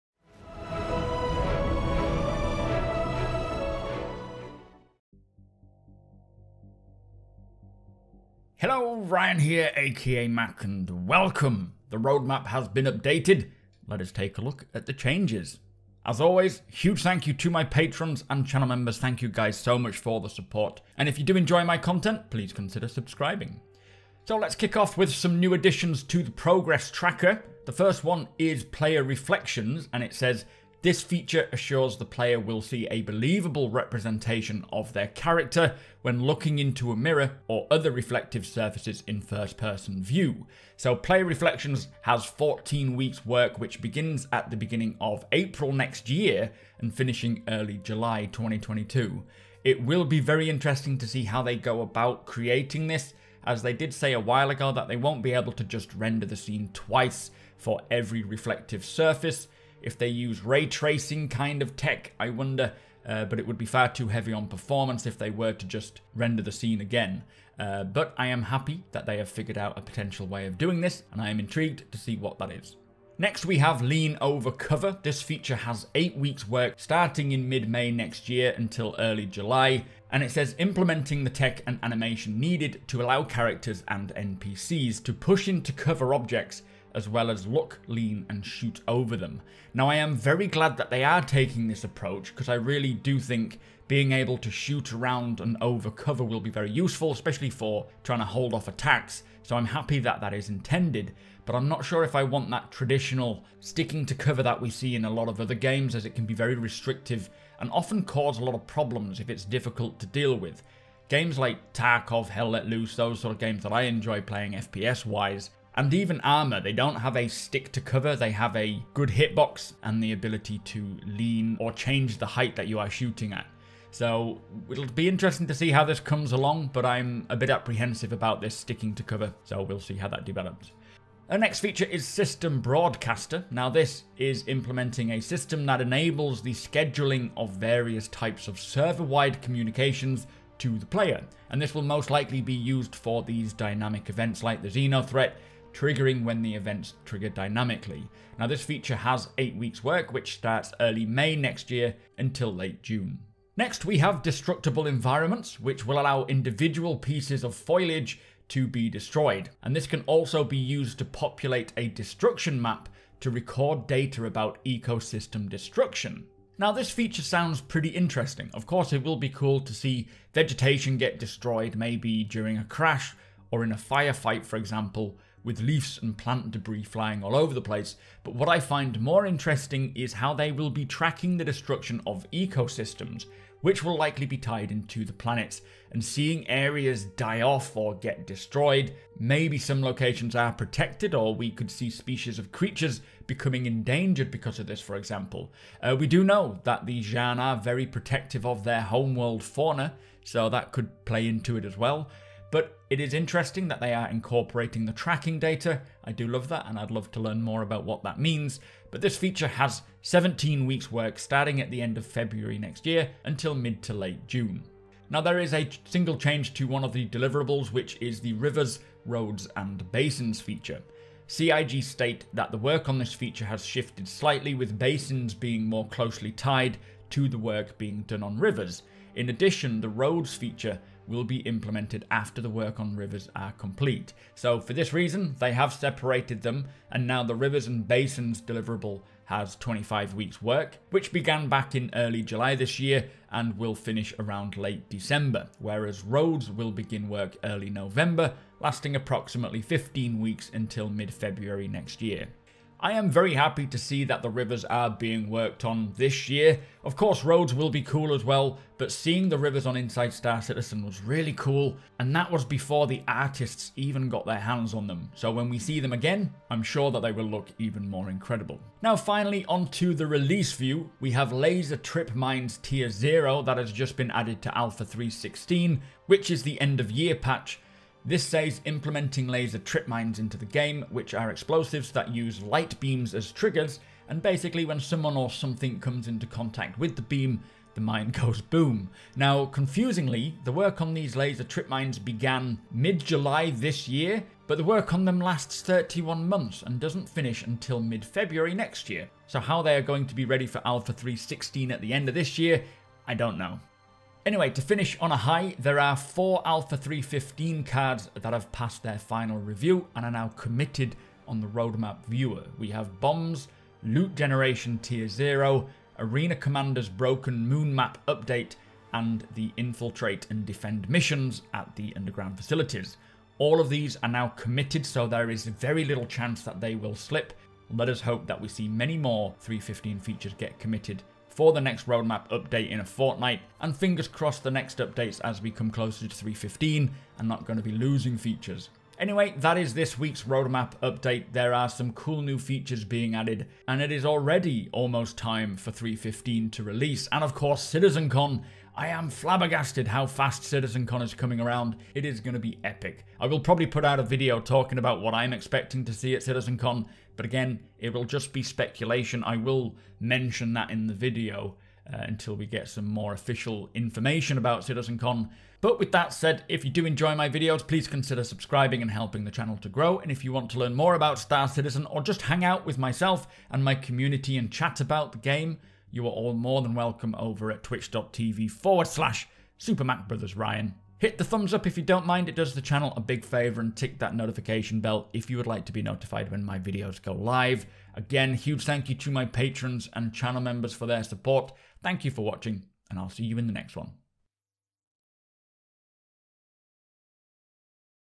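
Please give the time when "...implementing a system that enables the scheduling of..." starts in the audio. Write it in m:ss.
2:14.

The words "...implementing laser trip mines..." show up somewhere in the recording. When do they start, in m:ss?
4:38.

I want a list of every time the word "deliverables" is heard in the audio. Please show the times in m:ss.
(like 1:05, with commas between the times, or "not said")
3:37, 3:58.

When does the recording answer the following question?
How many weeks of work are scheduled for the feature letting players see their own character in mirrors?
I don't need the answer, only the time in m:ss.
0:42.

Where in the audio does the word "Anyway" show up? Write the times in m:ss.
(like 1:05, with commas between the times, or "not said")
5:04, 5:38.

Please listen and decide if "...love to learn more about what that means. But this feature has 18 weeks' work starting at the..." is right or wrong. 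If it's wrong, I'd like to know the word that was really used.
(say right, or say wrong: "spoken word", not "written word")
wrong: "17", not "18".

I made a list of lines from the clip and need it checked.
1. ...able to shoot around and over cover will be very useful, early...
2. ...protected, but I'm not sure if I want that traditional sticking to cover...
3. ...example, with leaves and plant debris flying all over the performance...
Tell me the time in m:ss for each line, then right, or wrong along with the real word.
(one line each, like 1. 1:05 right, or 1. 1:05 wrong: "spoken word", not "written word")
1. 1:34 wrong: "especially", not "early"
2. 1:40 wrong: "intended", not "protected"
3. 2:54 wrong: "place", not "performance".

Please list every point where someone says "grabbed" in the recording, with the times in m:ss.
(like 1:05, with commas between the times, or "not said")
not said.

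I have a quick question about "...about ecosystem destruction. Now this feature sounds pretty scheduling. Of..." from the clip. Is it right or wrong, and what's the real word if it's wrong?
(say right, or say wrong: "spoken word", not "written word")
wrong: "interesting", not "scheduling".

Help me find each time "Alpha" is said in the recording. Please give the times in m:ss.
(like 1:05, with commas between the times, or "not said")
4:34, 5:00, 5:06.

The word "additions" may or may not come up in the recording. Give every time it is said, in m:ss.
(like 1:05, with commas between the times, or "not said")
0:25, 3:49.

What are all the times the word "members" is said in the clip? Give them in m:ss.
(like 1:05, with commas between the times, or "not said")
0:18, 6:30.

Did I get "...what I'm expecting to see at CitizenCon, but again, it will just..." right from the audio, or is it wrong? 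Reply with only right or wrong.
right.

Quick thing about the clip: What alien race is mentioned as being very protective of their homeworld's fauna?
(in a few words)
Xi'an.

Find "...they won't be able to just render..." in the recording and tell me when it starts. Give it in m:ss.
0:54.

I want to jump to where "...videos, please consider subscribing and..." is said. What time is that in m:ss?
6:07.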